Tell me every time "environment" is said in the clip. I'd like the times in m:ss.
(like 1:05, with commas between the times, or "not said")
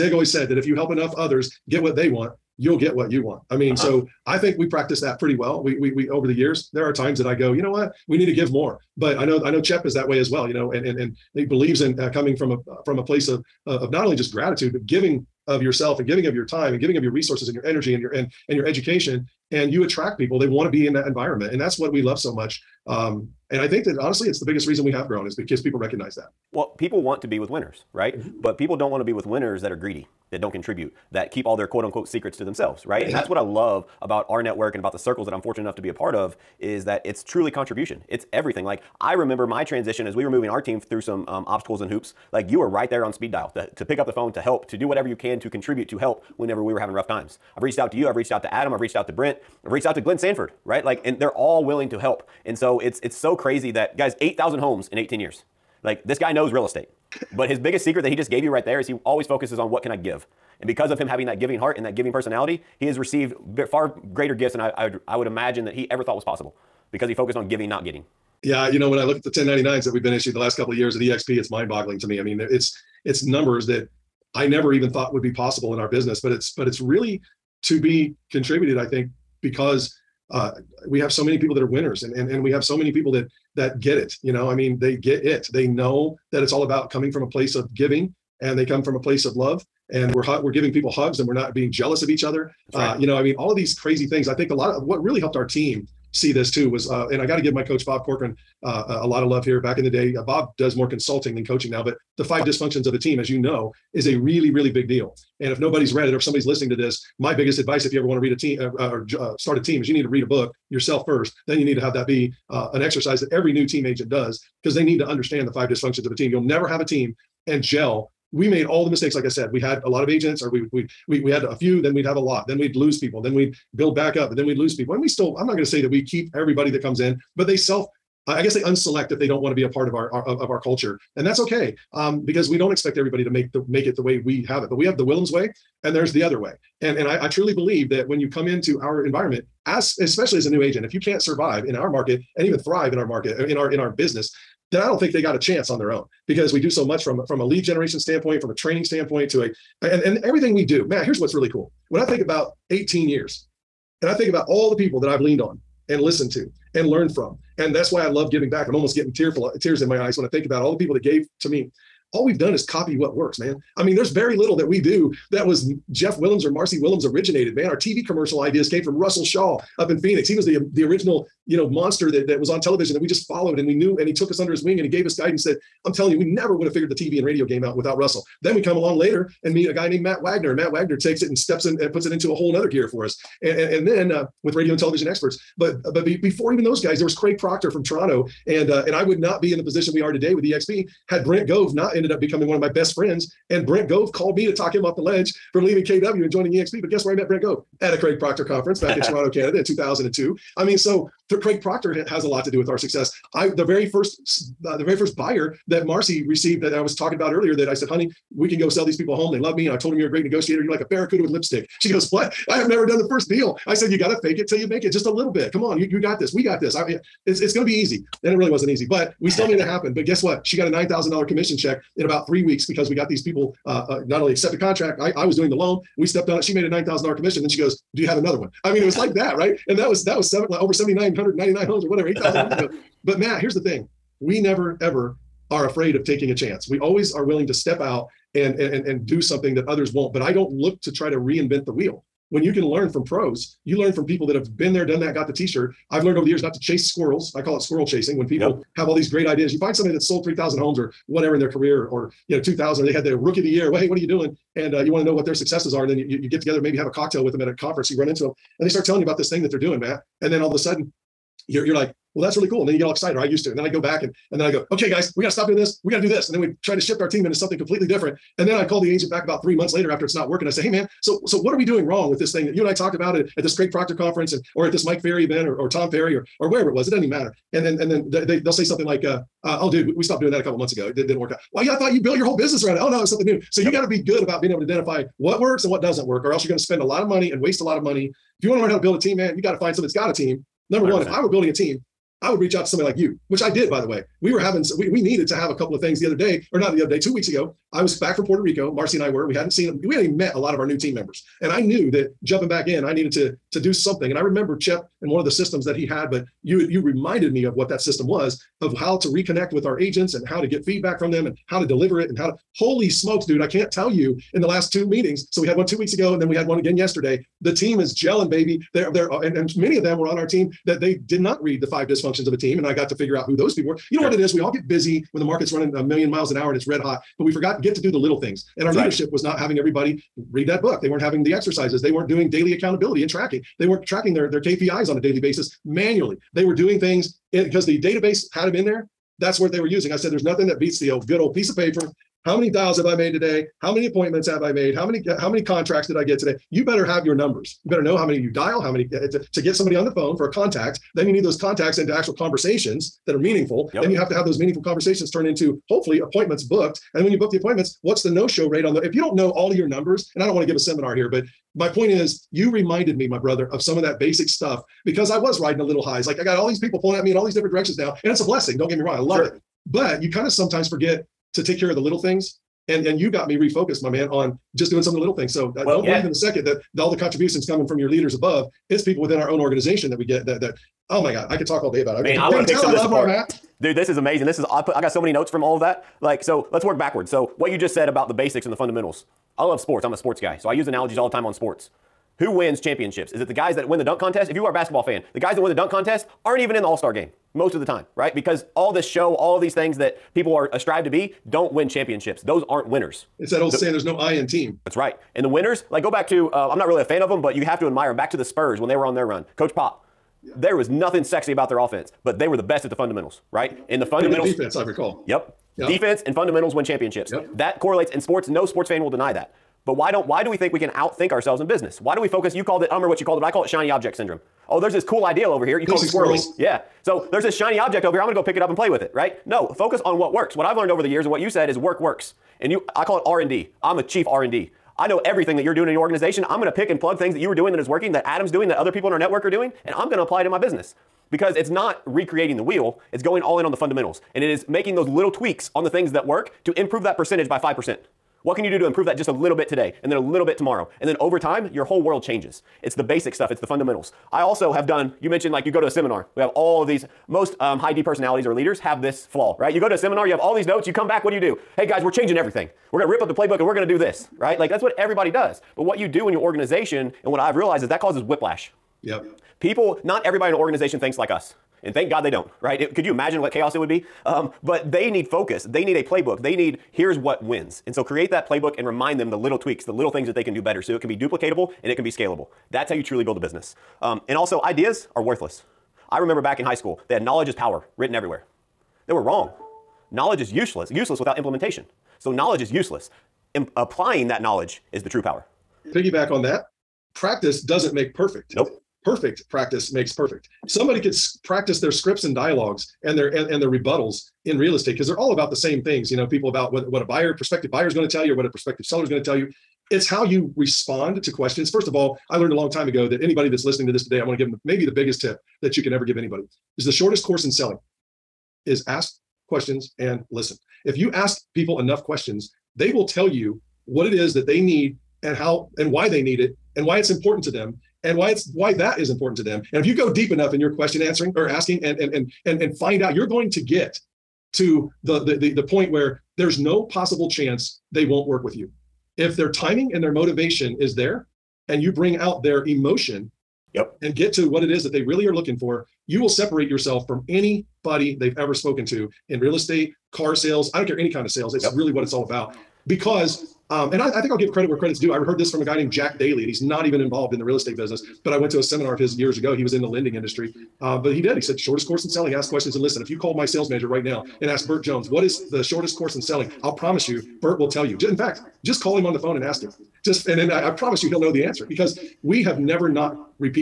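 0:21, 2:19.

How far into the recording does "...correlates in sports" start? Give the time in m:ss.
6:57.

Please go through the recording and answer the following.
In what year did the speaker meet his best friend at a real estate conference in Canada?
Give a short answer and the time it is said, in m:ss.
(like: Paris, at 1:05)
2002, at 3:19.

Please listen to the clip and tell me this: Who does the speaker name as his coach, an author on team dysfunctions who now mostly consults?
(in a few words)
Bob Corcoran.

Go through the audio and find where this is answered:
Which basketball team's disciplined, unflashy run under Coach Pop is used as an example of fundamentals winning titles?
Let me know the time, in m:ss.
6:48.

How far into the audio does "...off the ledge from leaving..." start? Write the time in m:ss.
3:14.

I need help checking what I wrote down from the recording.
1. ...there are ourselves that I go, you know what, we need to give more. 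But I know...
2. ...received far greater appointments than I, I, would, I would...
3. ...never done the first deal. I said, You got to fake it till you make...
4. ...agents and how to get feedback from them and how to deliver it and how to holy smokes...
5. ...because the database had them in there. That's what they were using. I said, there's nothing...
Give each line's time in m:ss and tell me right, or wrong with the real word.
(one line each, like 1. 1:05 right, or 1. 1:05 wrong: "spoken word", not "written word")
1. 0:06 wrong: "times", not "ourselves"
2. 1:02 wrong: "gifts", not "appointments"
3. 3:32 right
4. 5:09 right
5. 5:37 right.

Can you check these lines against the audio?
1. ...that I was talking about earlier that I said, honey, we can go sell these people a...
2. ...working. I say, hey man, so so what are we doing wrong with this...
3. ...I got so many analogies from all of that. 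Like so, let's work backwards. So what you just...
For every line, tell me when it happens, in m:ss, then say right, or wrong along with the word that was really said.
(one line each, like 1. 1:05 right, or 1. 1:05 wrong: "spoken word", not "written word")
1. 3:26 right
2. 4:30 right
3. 6:24 wrong: "notes", not "analogies".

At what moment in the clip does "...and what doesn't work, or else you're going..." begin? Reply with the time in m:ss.
4:45.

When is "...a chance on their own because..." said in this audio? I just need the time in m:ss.
2:25.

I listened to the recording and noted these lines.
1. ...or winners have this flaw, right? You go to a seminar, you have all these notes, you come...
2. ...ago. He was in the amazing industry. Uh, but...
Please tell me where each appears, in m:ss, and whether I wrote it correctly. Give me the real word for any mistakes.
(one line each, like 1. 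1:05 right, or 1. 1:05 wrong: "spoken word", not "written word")
1. 7:38 wrong: "leaders", not "winners"
2. 9:19 wrong: "lending", not "amazing".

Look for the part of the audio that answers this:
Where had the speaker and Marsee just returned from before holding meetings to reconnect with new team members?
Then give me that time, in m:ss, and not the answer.
4:58.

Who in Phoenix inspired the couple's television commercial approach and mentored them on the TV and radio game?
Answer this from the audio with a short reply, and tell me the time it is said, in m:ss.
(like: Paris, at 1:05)
Russell Shaw, at 2:48.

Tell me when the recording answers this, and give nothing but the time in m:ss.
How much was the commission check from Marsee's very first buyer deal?
3:40.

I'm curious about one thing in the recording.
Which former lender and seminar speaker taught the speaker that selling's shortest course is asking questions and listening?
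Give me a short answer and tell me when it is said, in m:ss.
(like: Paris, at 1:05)
Jack Daly, at 9:15.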